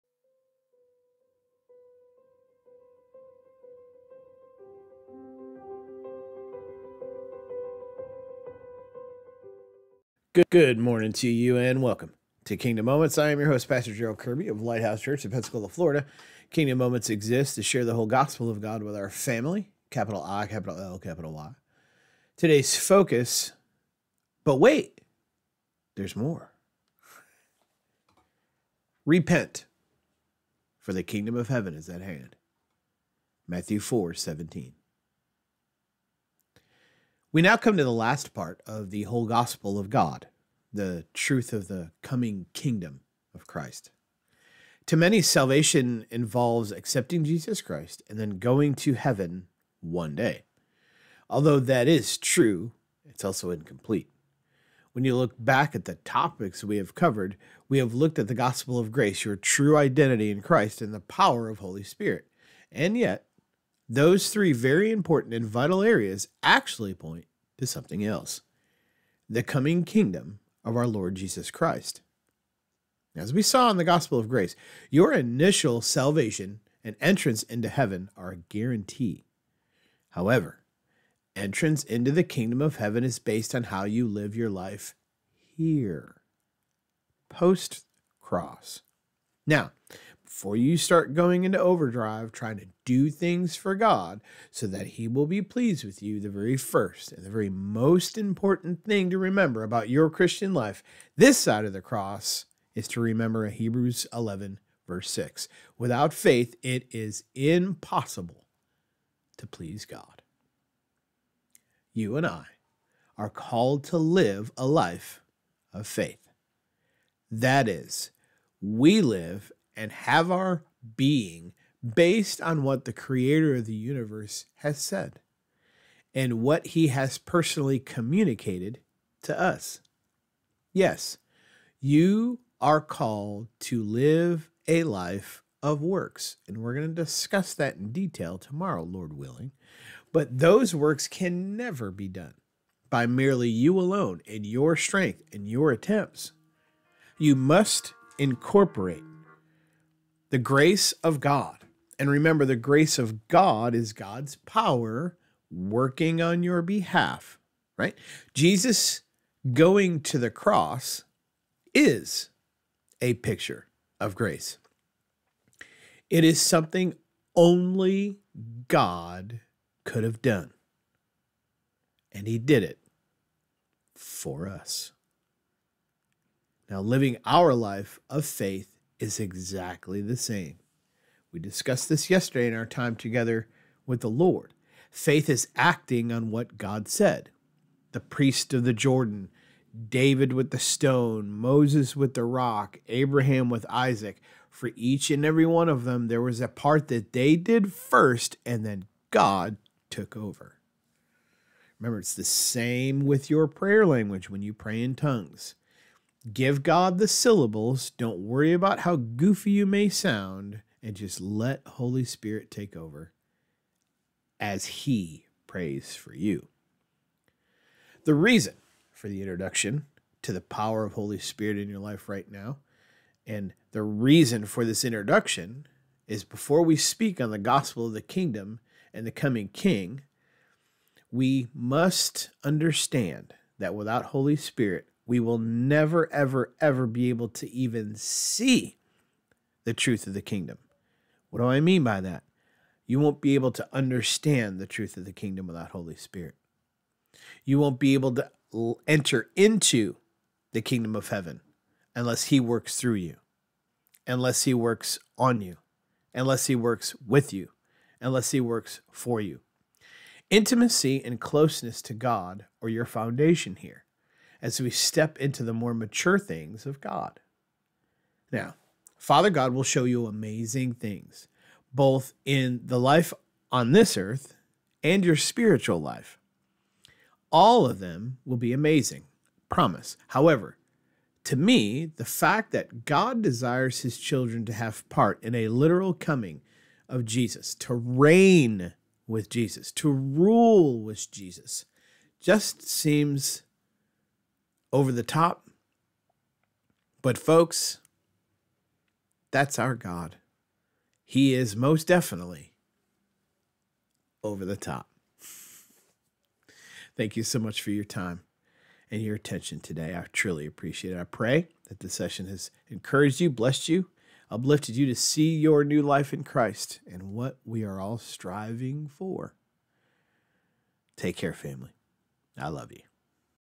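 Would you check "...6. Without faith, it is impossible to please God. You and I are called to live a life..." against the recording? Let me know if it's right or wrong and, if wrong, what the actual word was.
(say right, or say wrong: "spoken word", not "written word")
right.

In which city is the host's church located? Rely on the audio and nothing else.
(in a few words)
Pensacola.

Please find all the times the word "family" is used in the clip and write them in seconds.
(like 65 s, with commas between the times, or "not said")
19 s, 321 s.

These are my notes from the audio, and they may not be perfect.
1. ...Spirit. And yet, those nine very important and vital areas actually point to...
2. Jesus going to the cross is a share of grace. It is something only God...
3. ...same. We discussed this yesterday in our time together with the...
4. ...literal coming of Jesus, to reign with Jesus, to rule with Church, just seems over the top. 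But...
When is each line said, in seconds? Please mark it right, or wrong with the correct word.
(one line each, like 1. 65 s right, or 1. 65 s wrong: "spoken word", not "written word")
1. 61 s wrong: "three", not "nine"
2. 158 s wrong: "picture", not "share"
3. 180 s right
4. 285 s wrong: "Jesus", not "Church".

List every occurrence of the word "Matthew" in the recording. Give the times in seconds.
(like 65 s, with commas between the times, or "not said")
33 s.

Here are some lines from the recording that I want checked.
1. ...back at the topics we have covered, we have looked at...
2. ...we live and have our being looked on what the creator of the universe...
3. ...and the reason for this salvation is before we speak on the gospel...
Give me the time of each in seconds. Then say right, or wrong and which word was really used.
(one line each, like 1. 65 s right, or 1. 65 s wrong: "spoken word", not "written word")
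1. 55 s right
2. 118 s wrong: "based", not "looked"
3. 223 s wrong: "introduction", not "salvation".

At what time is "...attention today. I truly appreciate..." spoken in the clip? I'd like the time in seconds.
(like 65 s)
309 s.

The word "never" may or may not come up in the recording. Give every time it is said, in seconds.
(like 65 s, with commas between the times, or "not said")
141 s, 235 s.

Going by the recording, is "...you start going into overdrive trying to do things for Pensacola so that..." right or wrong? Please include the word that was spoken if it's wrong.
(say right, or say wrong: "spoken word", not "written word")
wrong: "God", not "Pensacola".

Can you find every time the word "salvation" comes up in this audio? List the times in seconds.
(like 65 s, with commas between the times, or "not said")
45 s, 75 s.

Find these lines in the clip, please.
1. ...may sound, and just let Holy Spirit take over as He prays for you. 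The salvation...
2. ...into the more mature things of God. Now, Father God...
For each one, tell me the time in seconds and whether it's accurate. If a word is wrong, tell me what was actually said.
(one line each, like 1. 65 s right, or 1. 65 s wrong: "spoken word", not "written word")
1. 209 s wrong: "reason", not "salvation"
2. 265 s right.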